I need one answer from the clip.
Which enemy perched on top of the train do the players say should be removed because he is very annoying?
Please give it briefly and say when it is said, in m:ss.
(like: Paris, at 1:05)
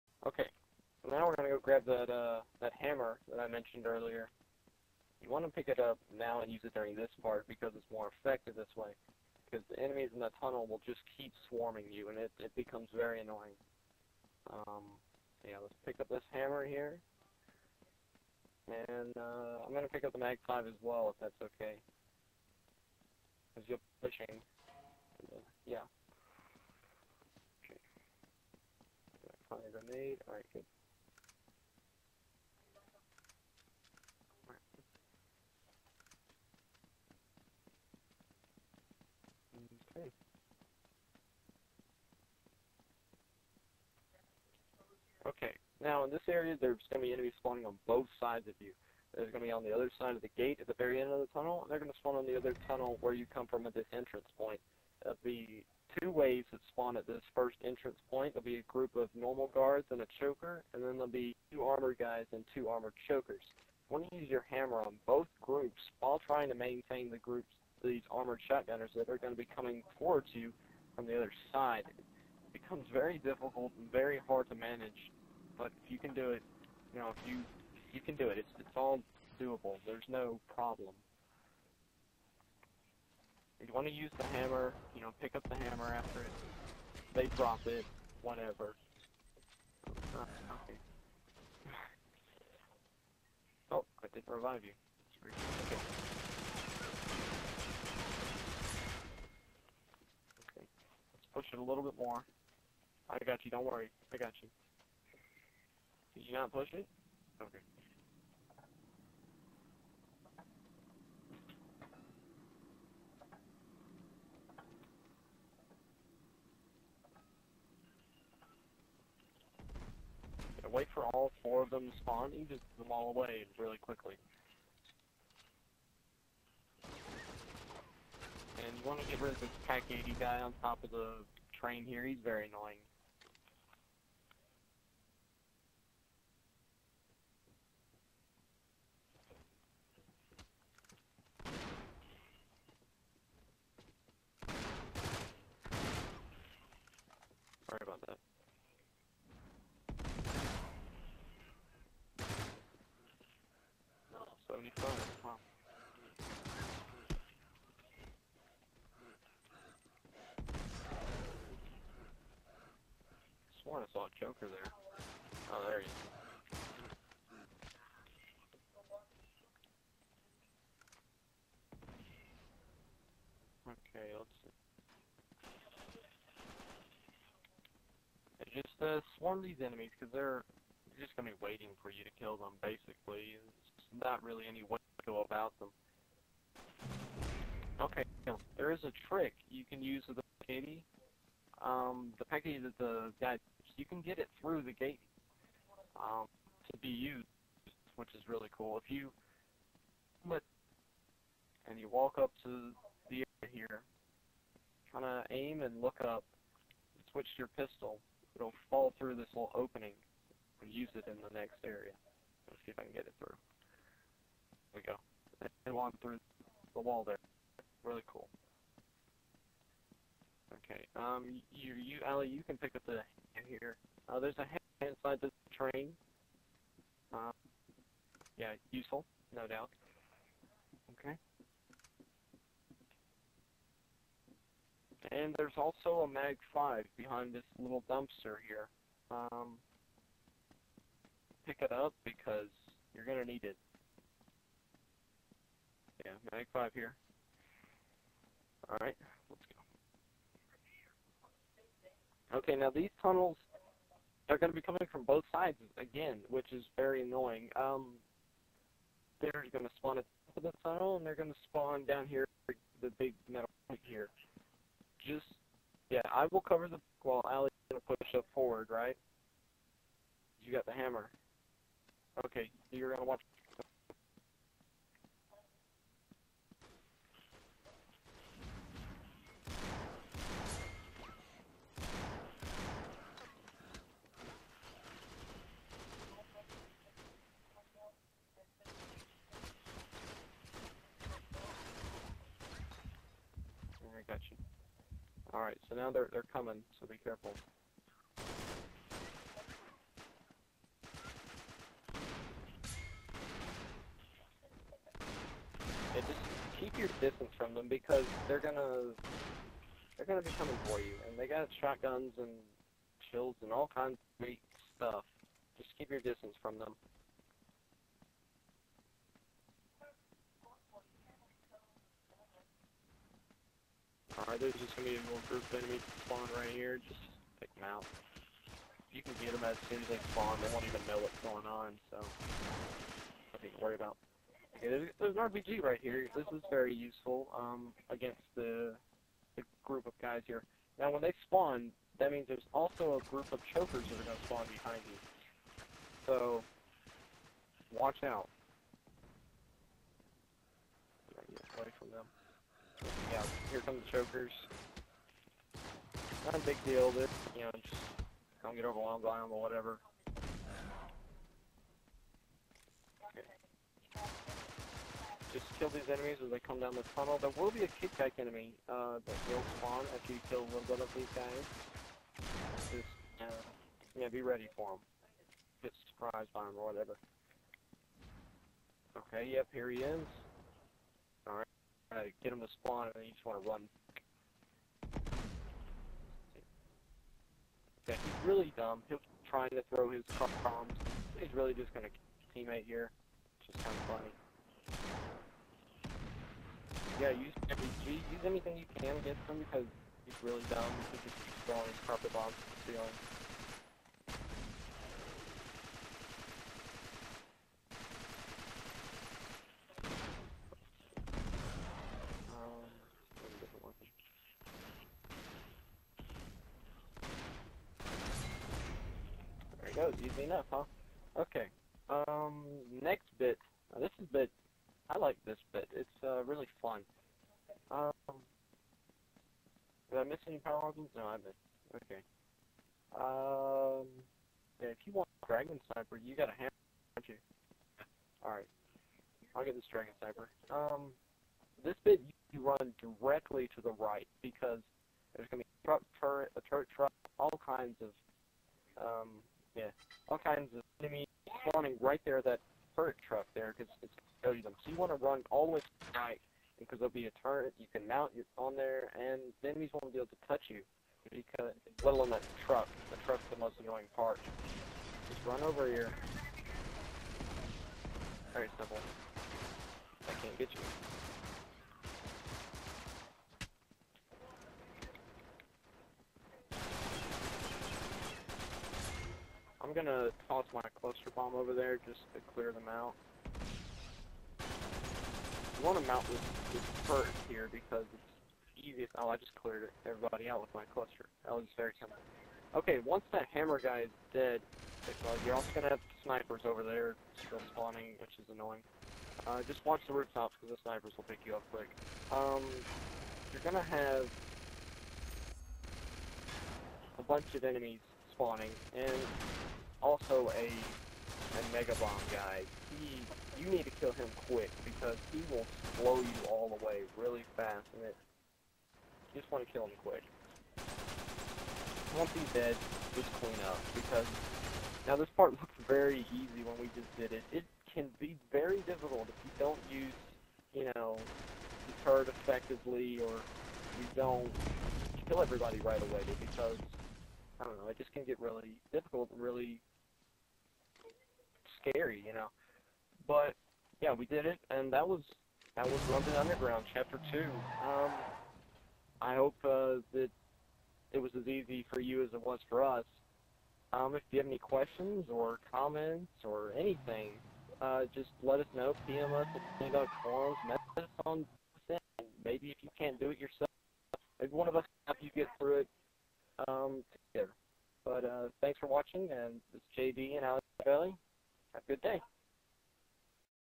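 Pak-80 guy, at 2:09.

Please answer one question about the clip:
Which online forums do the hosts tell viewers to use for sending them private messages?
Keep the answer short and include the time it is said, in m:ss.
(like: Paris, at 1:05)
Synagogue Forums, at 9:19.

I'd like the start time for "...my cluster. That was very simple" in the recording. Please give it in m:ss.
8:10.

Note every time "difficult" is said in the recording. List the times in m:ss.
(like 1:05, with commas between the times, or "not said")
1:13, 8:48, 8:58.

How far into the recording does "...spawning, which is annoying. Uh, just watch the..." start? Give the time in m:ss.
8:17.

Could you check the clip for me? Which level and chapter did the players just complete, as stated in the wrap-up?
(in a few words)
London Underground Chapter Two.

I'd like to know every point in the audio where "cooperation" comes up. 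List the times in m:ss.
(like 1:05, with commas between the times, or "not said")
not said.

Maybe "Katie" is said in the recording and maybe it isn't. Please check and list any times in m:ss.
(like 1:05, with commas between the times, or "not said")
3:10.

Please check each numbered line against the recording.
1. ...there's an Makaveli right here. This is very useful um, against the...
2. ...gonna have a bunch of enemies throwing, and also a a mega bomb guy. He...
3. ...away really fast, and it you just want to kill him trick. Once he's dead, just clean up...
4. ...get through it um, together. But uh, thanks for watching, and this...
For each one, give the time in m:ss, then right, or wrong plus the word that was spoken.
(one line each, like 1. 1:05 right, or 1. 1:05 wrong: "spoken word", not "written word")
1. 5:35 wrong: "RPG", not "Makaveli"
2. 8:23 wrong: "spawning", not "throwing"
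3. 8:36 wrong: "quick", not "trick"
4. 9:25 right.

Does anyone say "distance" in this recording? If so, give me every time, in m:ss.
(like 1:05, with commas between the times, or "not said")
5:07, 5:16.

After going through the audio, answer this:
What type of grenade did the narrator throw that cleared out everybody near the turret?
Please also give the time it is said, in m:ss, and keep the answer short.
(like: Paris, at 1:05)
Cluster bomb, at 8:00.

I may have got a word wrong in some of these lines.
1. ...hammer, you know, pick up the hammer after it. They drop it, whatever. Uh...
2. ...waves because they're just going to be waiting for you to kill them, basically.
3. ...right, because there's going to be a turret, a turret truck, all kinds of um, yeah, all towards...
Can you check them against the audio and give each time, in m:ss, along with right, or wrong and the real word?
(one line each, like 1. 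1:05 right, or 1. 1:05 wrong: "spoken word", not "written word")
1. 1:24 right
2. 2:59 wrong: "enemies", not "waves"
3. 7:23 wrong: "kinds", not "towards".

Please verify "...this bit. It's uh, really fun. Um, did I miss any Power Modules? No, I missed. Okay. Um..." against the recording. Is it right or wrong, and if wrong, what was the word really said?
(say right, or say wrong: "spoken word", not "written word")
right.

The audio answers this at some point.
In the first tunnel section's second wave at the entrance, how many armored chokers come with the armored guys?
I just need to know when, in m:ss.
1:02.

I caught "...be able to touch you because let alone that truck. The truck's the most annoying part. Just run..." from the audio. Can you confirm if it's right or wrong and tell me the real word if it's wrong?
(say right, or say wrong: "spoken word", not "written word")
right.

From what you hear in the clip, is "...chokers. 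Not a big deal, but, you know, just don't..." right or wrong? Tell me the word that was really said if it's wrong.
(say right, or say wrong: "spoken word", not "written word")
right.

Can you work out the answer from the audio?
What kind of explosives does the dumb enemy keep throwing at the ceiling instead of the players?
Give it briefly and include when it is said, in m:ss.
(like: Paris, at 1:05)
Car bombs, at 6:30.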